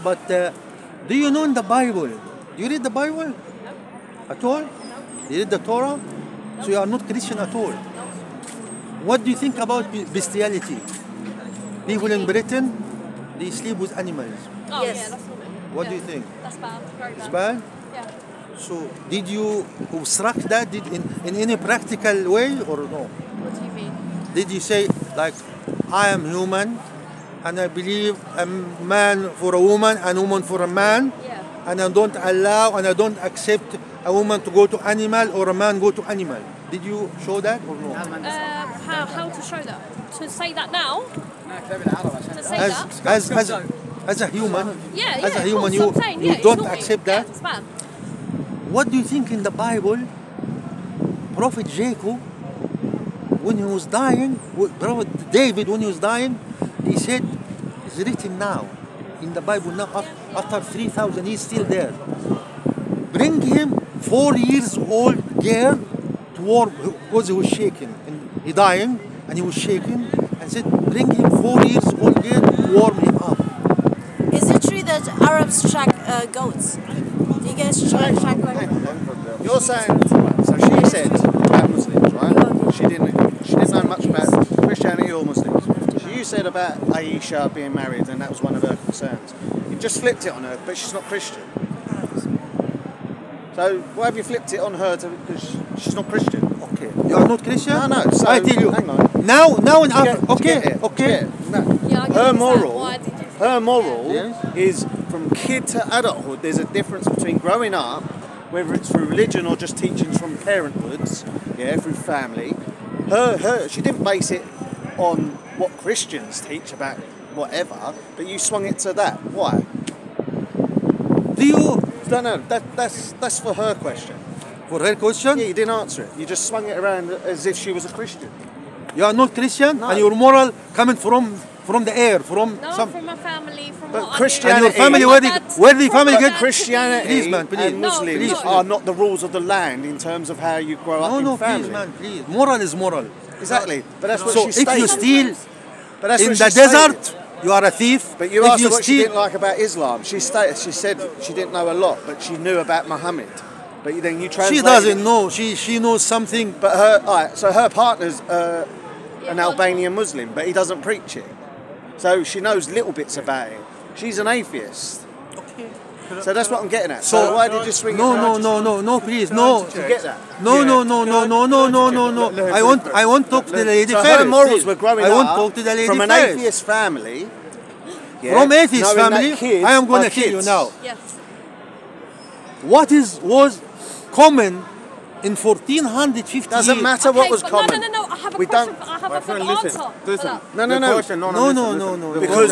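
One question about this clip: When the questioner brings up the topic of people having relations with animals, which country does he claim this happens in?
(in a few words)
Britain.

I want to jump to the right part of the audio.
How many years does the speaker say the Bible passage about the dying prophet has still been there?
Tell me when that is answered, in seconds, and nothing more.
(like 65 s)
60 s.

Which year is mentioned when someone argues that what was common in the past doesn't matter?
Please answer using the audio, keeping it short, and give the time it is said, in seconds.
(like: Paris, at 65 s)
1450, at 185 s.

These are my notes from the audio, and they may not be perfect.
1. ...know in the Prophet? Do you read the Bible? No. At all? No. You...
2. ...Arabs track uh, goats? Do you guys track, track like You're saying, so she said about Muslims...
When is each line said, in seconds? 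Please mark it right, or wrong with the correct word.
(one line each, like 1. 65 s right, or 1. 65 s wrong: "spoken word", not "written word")
1. 1 s wrong: "Bible", not "Prophet"
2. 75 s right.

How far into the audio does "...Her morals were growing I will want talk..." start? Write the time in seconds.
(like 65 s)
174 s.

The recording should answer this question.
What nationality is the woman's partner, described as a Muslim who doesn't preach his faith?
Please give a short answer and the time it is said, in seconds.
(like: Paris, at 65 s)
Albanian, at 159 s.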